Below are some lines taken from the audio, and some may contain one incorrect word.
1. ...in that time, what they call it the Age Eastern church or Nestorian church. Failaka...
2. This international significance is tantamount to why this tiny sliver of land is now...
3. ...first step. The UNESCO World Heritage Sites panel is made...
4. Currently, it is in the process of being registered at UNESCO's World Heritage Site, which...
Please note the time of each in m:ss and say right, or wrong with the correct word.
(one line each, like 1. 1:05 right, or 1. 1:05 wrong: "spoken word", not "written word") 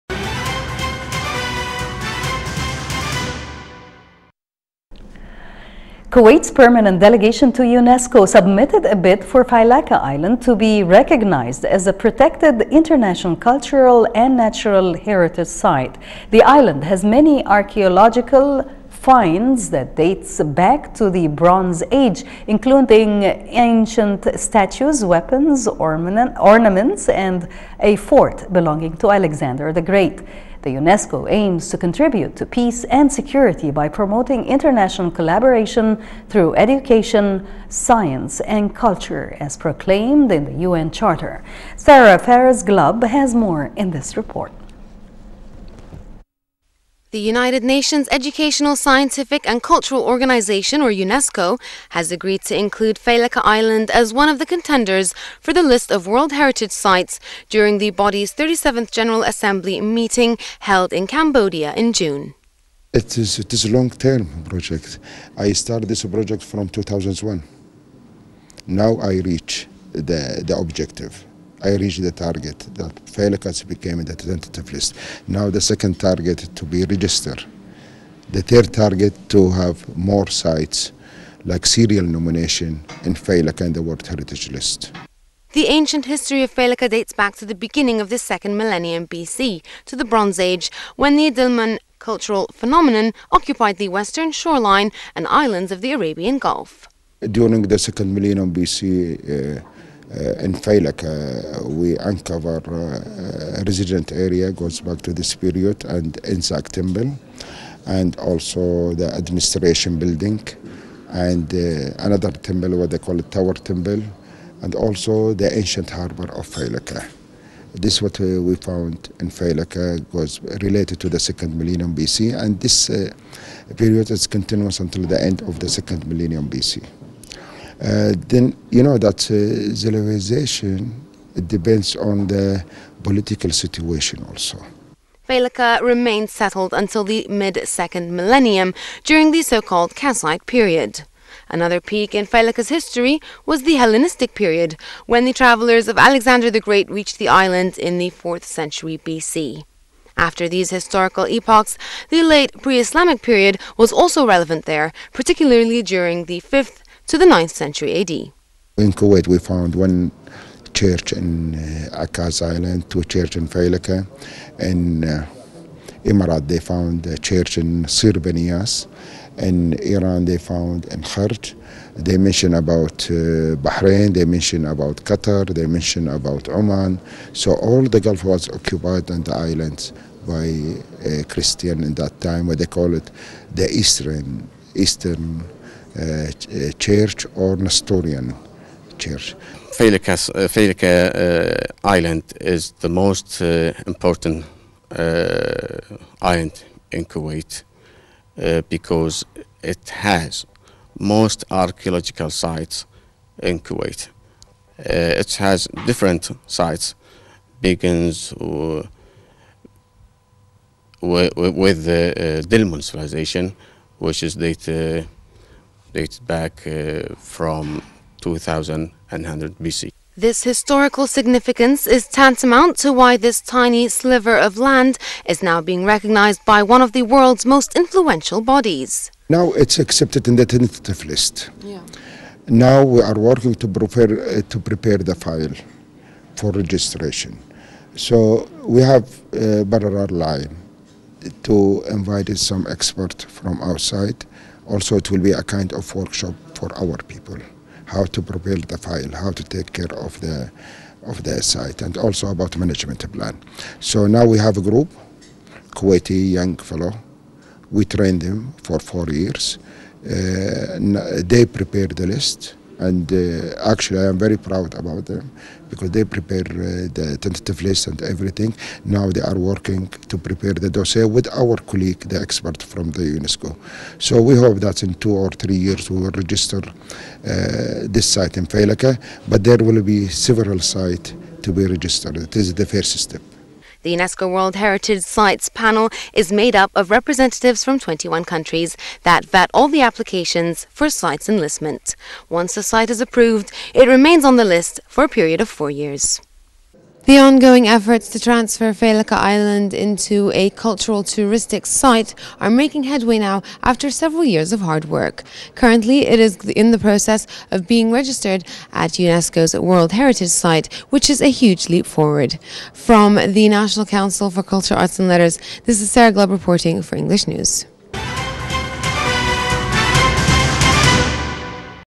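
1. 3:01 wrong: "Eastern", not "Age"
2. 3:40 wrong: "historical", not "international"
3. 4:42 right
4. 5:05 right.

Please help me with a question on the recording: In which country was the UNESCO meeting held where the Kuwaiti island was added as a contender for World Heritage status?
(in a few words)
Cambodia.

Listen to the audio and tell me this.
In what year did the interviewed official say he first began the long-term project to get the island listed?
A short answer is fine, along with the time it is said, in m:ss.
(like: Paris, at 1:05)
2001, at 1:06.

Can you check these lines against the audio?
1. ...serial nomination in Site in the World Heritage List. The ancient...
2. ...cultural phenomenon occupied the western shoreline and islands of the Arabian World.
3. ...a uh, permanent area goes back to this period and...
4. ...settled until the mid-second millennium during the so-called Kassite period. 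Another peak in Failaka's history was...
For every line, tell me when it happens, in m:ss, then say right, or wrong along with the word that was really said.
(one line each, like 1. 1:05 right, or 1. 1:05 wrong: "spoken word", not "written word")
1. 1:21 wrong: "Failaka", not "Site"
2. 1:31 wrong: "Gulf", not "World"
3. 1:42 wrong: "resident", not "permanent"
4. 2:16 right.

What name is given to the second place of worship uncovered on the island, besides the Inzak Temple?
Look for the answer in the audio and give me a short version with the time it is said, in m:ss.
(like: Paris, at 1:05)
Tower Temple, at 1:53.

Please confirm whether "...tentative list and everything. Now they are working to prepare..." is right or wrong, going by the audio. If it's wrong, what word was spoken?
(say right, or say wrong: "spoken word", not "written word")
right.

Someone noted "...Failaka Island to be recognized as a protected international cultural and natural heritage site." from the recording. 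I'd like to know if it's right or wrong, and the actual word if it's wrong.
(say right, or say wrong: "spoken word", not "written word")
right.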